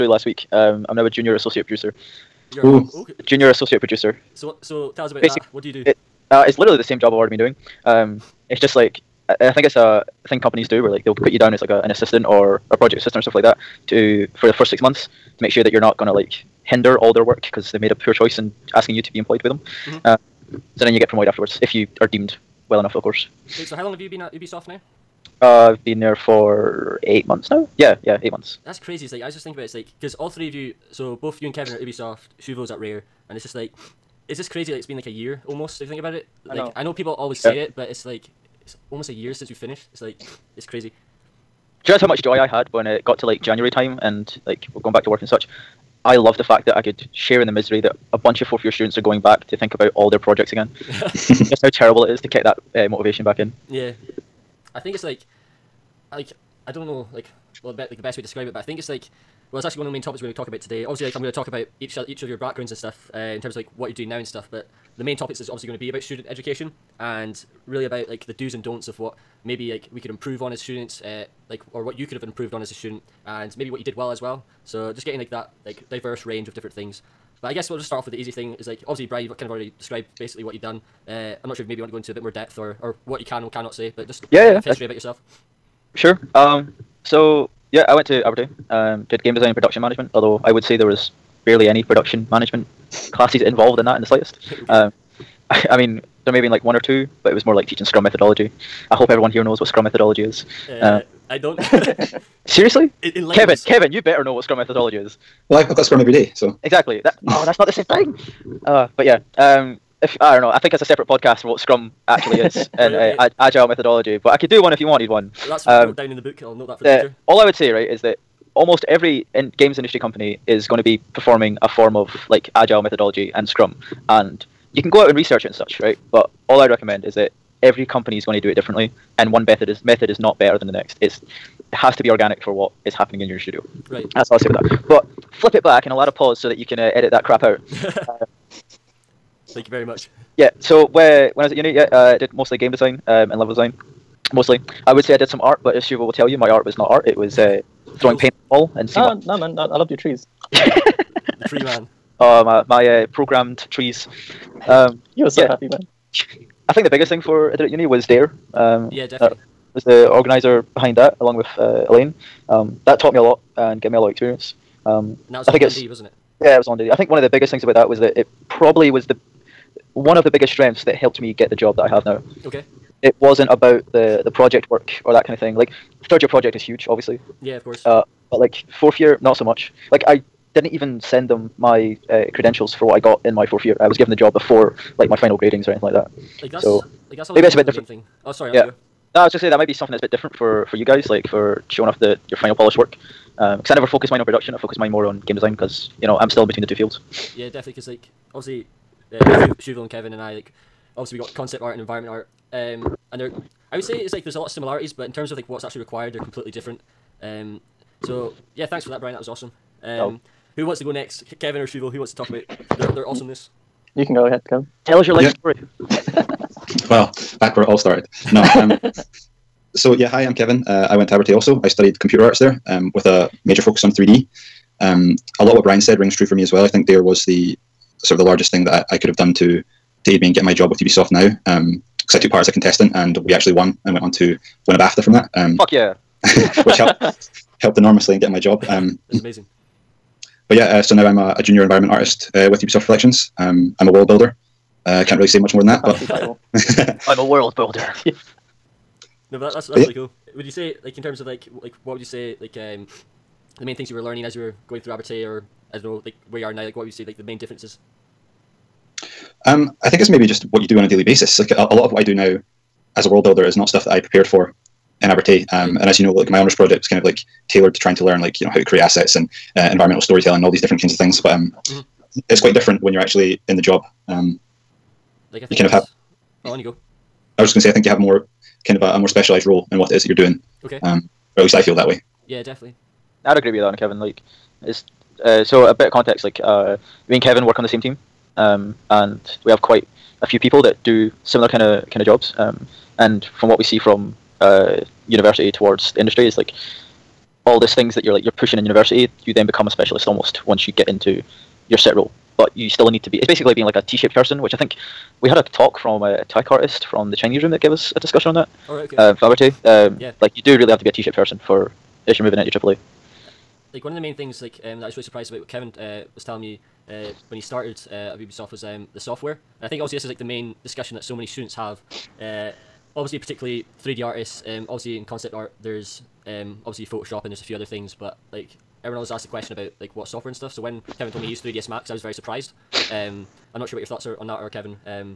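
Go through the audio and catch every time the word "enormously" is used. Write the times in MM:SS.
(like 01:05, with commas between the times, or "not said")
03:57.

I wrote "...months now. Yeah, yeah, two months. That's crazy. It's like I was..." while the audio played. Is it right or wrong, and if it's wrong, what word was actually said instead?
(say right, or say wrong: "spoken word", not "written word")
wrong: "eight", not "two".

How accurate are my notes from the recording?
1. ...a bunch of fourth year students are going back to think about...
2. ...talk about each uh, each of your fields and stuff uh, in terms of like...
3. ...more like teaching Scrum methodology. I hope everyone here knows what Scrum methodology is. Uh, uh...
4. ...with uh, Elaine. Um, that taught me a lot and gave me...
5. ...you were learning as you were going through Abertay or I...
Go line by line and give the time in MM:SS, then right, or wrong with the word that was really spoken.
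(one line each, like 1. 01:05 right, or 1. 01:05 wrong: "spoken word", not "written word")
1. 00:48 right
2. 01:01 wrong: "backgrounds", not "fields"
3. 01:37 right
4. 02:41 right
5. 04:13 right.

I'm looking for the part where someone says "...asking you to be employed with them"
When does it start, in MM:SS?
00:18.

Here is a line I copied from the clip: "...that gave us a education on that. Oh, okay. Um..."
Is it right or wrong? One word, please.
wrong.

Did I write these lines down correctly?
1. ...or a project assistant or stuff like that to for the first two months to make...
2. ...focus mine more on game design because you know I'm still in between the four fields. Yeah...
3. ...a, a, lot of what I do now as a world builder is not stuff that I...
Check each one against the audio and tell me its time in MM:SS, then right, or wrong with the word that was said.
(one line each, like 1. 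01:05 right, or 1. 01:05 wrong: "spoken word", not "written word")
1. 00:12 wrong: "six", not "two"
2. 03:14 wrong: "two", not "four"
3. 04:21 right.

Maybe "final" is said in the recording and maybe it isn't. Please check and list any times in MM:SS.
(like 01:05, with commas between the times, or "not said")
03:05, 03:12.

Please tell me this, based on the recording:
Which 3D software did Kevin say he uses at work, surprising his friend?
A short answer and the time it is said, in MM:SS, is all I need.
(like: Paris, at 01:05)
3ds Max, at 05:31.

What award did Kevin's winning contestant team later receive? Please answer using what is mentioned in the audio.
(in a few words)
BAFTA.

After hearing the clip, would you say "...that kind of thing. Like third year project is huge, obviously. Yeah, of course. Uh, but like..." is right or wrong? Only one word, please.
right.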